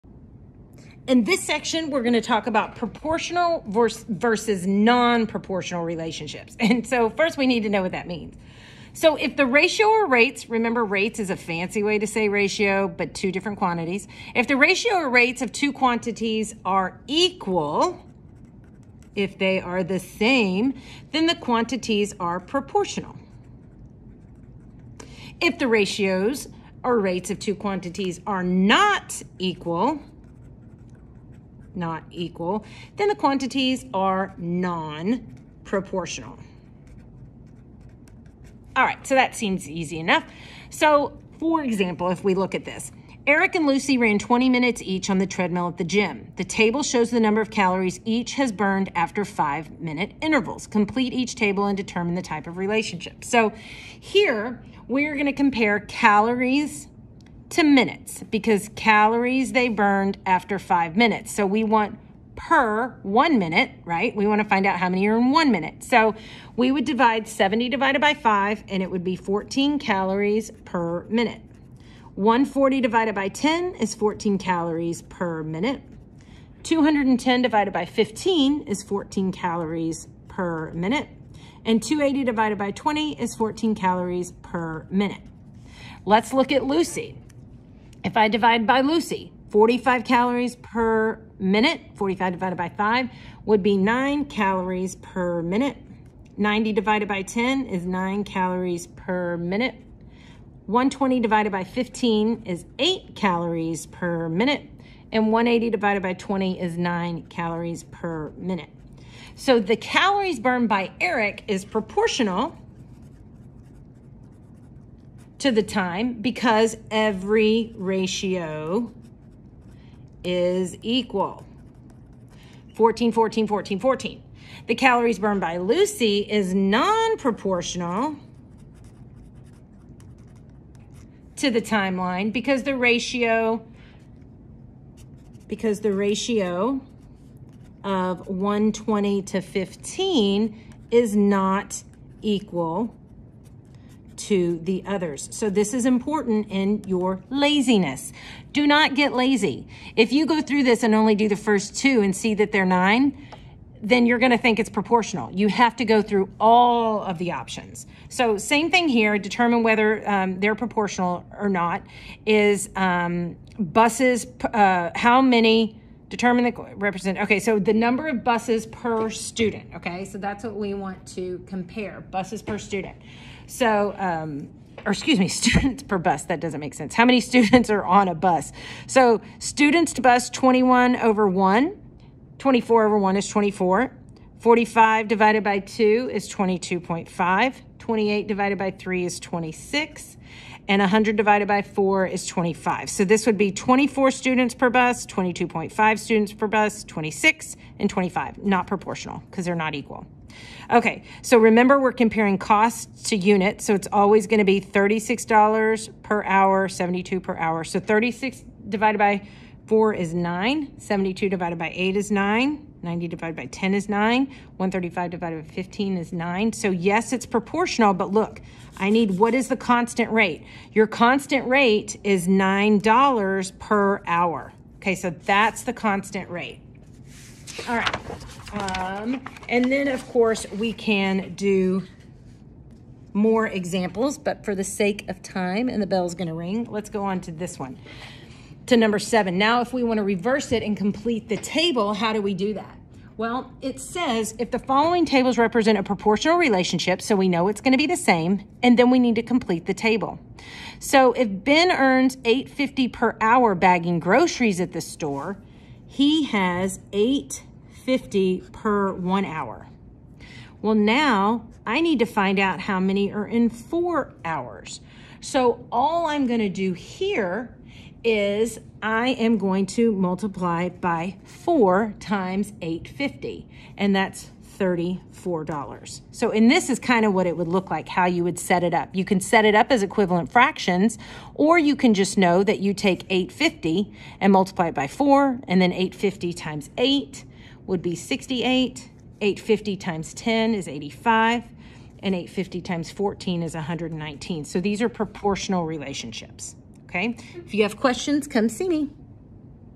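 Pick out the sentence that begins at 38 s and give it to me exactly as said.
All right, so that seems easy enough.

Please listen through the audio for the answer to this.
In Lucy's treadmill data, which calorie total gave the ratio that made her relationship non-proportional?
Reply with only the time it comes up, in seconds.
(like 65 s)
100 s.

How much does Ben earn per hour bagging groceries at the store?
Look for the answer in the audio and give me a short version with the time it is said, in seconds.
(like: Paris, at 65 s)
$8.50, at 252 s.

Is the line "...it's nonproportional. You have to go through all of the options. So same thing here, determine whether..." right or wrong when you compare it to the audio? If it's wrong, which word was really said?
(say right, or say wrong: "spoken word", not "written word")
wrong: "proportional", not "nonproportional".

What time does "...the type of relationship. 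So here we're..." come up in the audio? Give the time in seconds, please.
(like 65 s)
52 s.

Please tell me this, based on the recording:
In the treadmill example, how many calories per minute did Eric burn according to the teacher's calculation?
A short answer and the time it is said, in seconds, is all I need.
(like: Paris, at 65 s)
14, at 68 s.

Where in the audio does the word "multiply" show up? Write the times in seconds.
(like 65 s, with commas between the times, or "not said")
269 s, 284 s.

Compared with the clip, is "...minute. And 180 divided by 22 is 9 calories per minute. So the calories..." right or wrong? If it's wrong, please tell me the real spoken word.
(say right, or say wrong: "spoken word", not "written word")
wrong: "20", not "22".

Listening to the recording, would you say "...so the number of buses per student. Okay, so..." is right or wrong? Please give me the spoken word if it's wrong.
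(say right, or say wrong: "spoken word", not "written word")
right.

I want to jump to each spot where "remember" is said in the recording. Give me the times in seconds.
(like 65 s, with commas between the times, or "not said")
10 s, 201 s.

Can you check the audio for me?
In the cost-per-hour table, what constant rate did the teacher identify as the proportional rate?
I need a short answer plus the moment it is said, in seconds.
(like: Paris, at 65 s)
$9 per hour, at 222 s.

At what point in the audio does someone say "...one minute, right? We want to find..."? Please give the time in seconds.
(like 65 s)
63 s.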